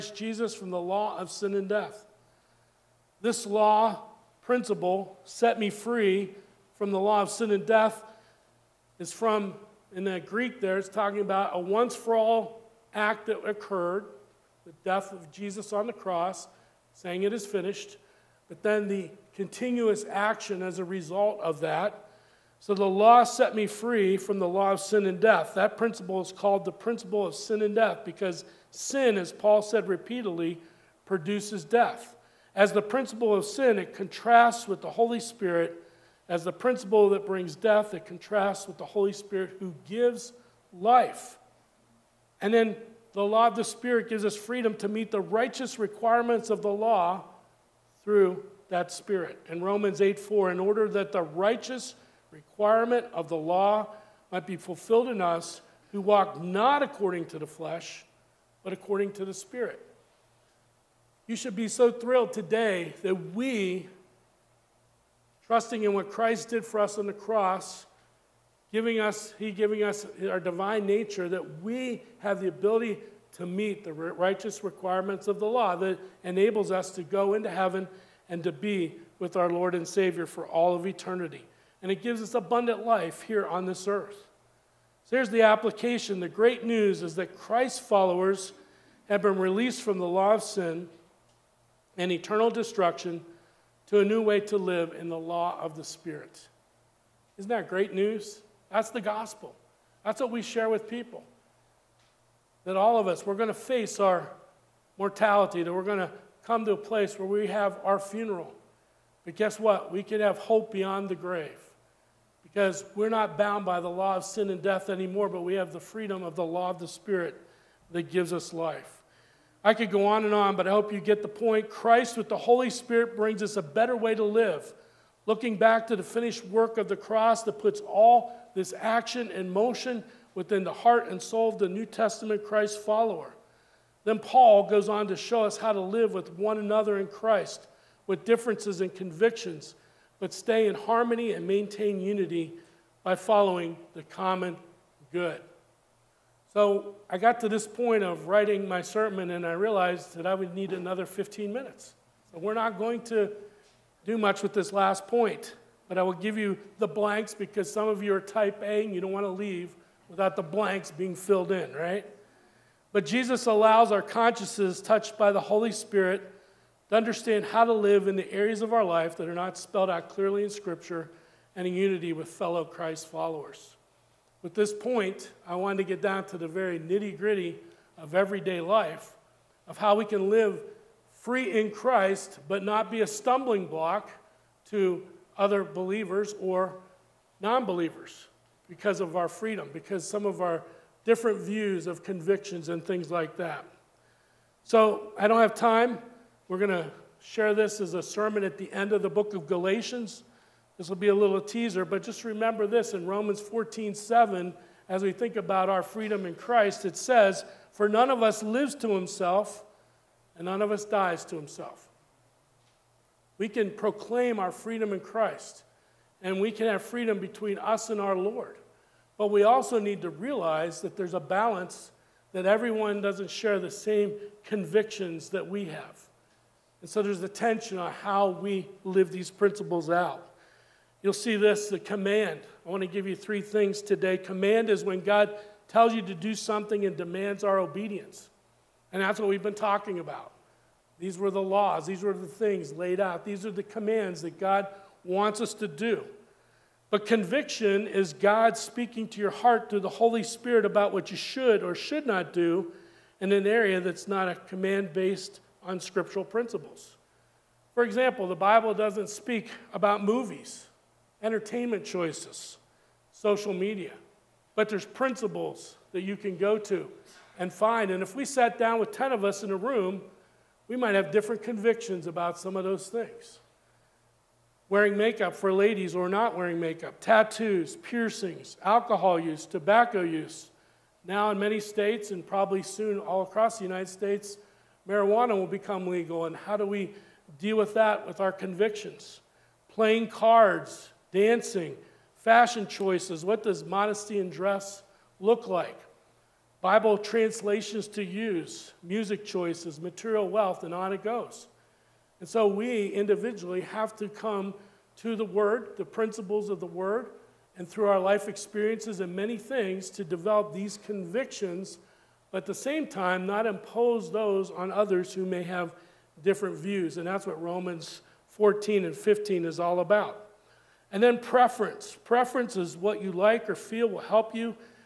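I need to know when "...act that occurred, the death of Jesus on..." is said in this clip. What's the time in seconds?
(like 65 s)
12 s.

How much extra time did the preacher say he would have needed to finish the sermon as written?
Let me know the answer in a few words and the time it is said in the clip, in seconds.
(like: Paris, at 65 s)
15 minutes, at 151 s.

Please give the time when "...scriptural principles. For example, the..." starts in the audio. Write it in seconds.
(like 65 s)
255 s.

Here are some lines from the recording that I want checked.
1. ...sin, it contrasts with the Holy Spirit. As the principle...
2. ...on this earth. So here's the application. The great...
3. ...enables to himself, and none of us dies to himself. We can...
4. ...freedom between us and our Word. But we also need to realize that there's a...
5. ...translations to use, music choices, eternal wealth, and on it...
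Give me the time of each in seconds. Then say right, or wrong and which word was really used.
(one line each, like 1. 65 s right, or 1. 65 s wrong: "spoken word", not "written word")
1. 33 s right
2. 83 s right
3. 208 s wrong: "lives", not "enables"
4. 216 s wrong: "Lord", not "Word"
5. 296 s wrong: "material", not "eternal".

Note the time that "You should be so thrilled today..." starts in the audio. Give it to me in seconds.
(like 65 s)
61 s.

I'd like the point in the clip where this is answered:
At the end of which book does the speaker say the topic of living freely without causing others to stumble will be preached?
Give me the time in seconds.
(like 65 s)
199 s.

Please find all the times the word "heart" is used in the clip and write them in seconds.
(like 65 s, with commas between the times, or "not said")
130 s, 249 s.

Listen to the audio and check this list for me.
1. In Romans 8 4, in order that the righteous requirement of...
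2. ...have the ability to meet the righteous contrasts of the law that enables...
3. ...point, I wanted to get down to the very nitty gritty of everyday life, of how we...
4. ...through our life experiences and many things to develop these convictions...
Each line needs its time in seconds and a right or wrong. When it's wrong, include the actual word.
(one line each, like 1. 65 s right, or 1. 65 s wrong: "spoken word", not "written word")
1. 49 s right
2. 72 s wrong: "requirements", not "contrasts"
3. 174 s right
4. 307 s right.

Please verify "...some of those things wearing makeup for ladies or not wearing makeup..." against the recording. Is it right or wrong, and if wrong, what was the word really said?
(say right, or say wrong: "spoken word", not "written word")
right.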